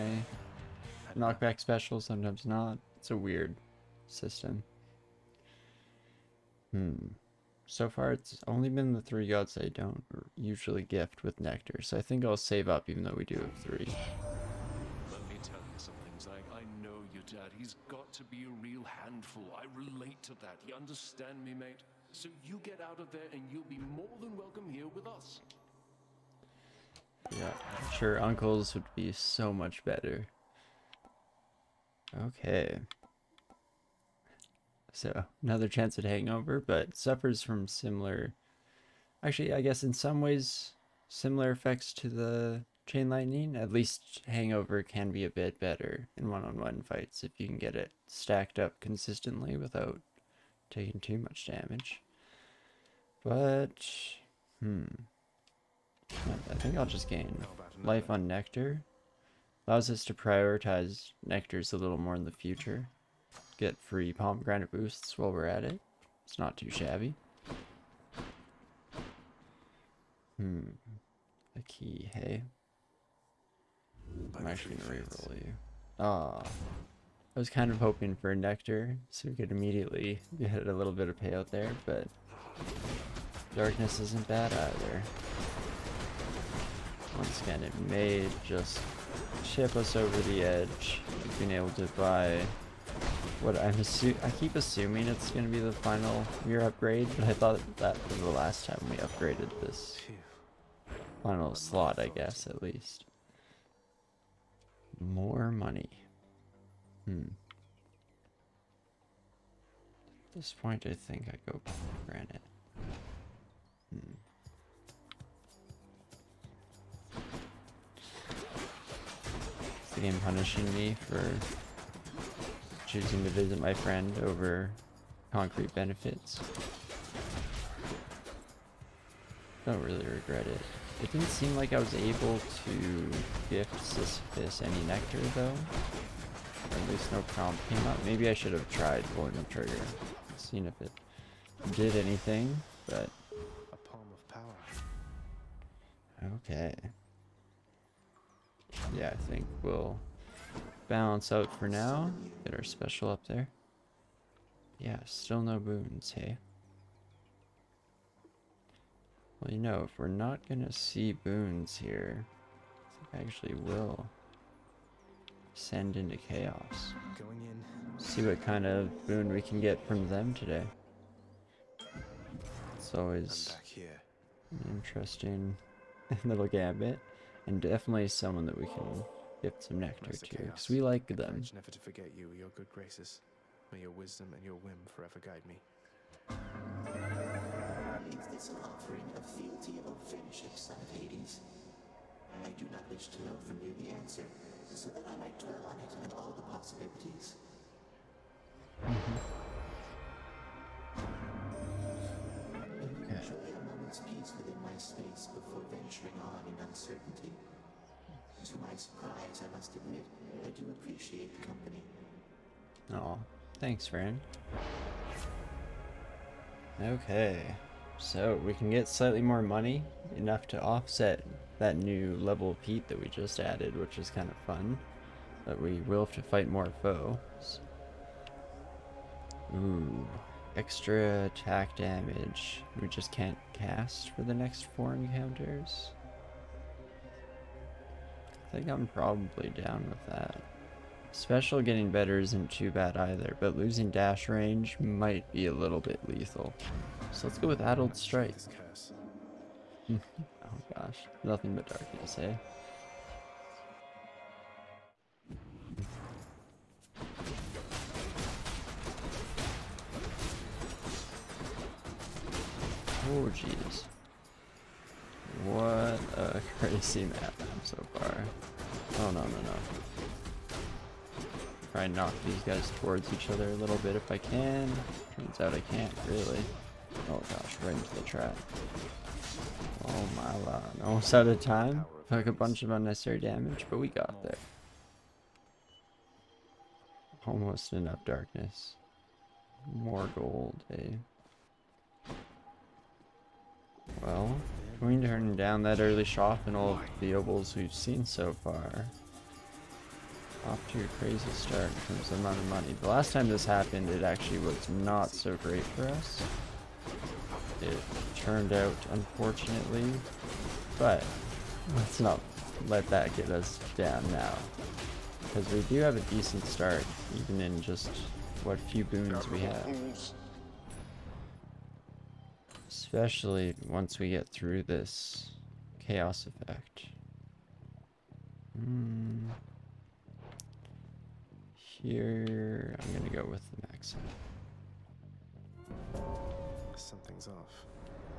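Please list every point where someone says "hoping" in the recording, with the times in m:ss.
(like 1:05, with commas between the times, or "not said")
1:17.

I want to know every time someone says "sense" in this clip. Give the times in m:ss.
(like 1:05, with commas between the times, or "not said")
not said.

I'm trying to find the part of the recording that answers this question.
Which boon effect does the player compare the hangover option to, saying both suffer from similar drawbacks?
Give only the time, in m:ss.
0:42.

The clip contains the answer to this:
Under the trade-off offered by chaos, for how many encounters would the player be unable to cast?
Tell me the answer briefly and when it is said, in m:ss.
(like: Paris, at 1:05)
4, at 3:54.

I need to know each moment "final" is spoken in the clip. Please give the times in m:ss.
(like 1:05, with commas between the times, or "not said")
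1:35, 1:41.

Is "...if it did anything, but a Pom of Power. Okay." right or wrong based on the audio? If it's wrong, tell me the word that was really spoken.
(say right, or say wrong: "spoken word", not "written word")
right.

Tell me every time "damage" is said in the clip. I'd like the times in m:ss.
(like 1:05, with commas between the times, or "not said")
0:51, 3:51, 4:43.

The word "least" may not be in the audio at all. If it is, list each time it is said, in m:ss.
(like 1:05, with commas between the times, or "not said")
0:43, 1:42, 2:16.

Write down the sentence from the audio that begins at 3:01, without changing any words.
never to forget you, your good graces.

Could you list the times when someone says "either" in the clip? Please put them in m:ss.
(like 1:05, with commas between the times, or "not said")
1:24, 4:02.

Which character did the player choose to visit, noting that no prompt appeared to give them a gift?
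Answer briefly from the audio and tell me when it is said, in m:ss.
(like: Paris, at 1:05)
Sisyphus, at 2:13.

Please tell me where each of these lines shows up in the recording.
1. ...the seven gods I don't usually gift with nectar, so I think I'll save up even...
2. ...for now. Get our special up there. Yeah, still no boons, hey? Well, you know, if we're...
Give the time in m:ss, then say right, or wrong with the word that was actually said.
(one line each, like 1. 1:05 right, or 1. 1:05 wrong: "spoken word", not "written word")
1. 0:08 wrong: "three", not "seven"
2. 2:31 right.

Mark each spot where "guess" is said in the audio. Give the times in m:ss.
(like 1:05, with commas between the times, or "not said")
0:39, 1:42.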